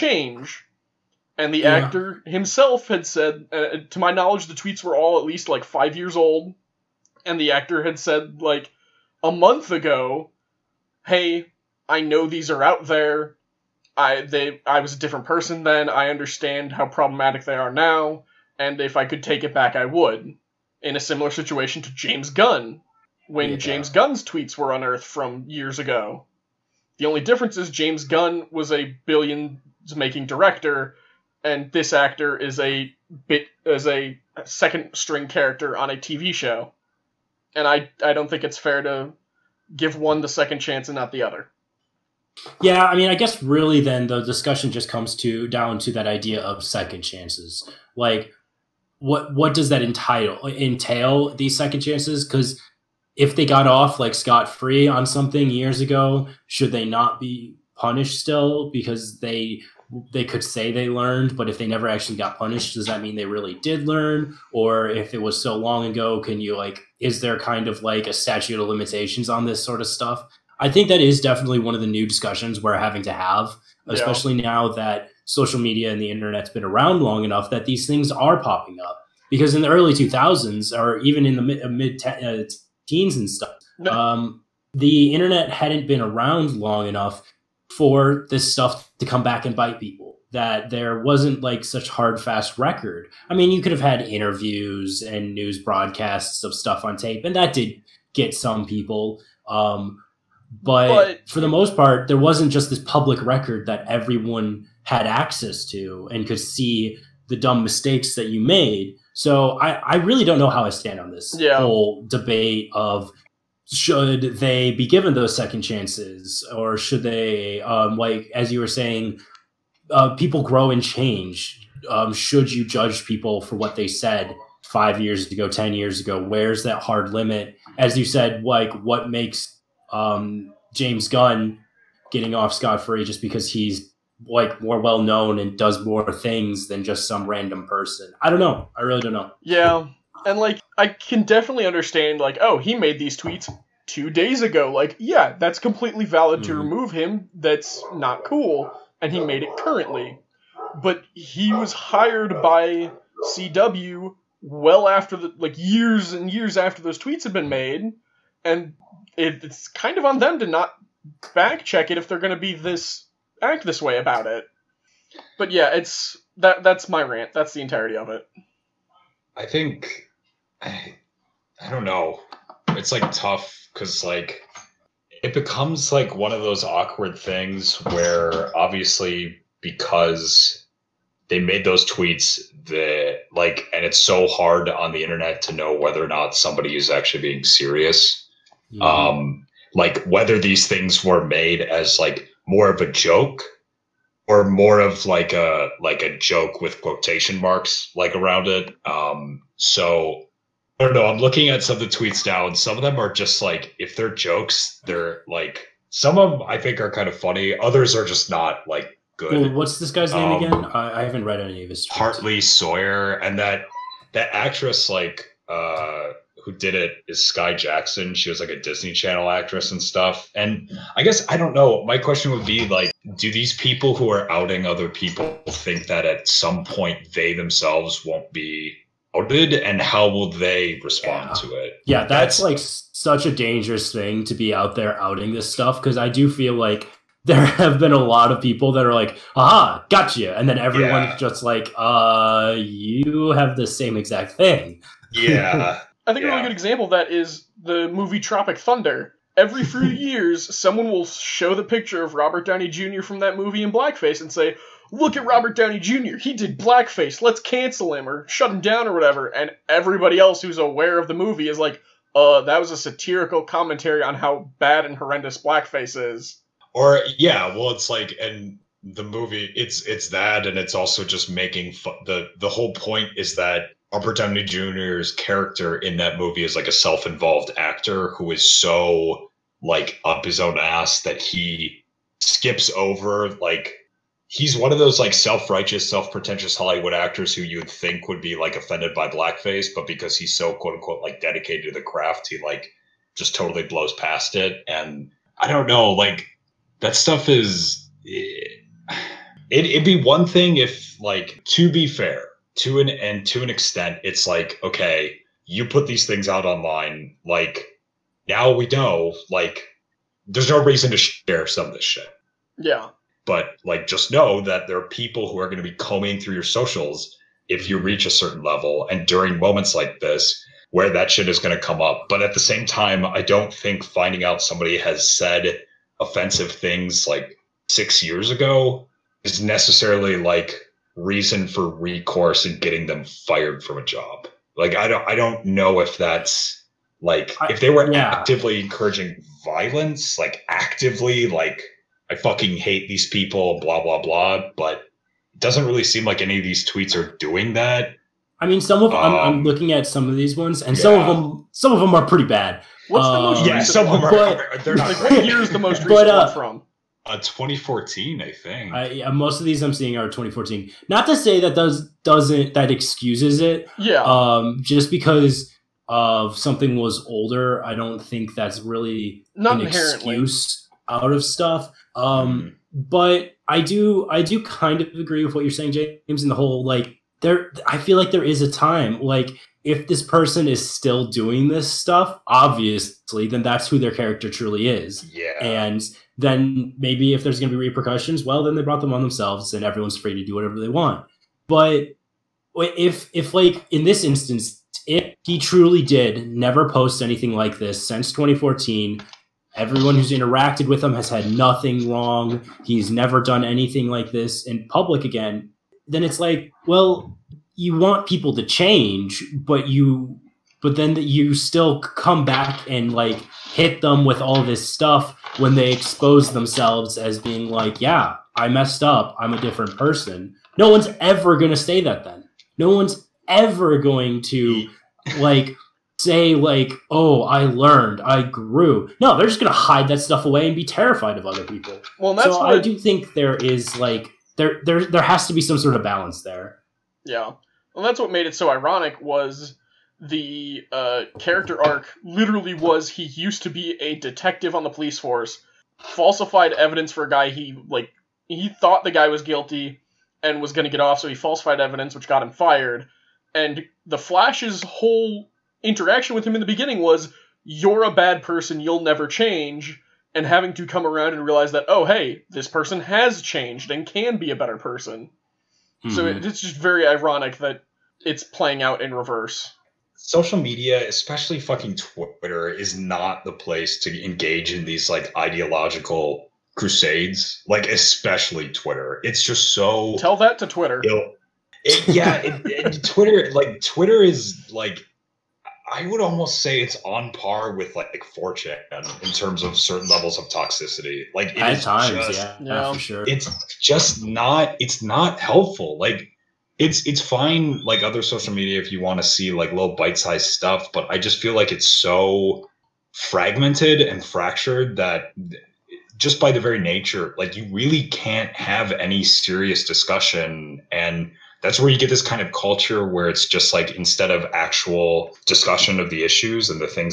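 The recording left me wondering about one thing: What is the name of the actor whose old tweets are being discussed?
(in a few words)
Hartley Sawyer.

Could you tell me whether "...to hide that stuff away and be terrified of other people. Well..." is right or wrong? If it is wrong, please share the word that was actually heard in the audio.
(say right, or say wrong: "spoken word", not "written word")
right.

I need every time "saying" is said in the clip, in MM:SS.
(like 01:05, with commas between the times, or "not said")
01:58, 06:15.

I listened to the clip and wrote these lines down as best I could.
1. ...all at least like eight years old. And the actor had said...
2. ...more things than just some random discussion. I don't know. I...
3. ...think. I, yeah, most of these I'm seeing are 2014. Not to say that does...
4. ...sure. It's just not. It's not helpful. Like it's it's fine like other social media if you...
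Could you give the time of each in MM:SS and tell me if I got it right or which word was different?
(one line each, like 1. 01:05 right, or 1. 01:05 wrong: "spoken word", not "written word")
1. 00:04 wrong: "five", not "eight"
2. 02:15 wrong: "person", not "discussion"
3. 05:58 right
4. 08:12 right.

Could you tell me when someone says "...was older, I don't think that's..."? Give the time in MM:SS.
06:06.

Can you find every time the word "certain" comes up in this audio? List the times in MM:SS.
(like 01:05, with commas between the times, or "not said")
05:18, 08:09.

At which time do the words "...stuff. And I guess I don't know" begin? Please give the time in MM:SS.
03:39.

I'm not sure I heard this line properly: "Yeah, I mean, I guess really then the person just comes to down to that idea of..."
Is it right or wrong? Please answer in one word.
wrong.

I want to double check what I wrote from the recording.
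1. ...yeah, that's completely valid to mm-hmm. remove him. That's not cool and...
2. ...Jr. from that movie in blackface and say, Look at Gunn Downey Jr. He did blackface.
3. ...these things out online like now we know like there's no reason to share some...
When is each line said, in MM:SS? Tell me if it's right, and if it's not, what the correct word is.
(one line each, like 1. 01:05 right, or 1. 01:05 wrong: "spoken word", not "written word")
1. 02:24 right
2. 04:12 wrong: "Robert", not "Gunn"
3. 05:05 right.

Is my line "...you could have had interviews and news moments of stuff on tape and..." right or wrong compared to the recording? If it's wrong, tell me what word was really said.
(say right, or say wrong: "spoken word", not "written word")
wrong: "broadcasts", not "moments".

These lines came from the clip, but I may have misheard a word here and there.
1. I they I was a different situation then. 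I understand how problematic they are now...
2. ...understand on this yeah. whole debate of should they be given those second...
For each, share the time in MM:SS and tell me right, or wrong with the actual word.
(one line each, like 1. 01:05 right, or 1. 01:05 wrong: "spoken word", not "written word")
1. 00:13 wrong: "person", not "situation"
2. 01:50 wrong: "stand", not "understand".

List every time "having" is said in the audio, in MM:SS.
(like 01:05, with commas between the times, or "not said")
01:12, 07:40.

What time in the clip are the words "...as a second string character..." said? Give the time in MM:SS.
00:33.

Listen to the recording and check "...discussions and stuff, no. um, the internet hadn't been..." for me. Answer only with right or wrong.
wrong.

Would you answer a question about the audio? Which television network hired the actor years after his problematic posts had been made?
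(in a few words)
CW.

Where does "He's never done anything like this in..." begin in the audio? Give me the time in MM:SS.
06:42.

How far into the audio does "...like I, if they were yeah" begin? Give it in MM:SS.
05:37.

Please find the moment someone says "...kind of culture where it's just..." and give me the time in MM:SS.
08:32.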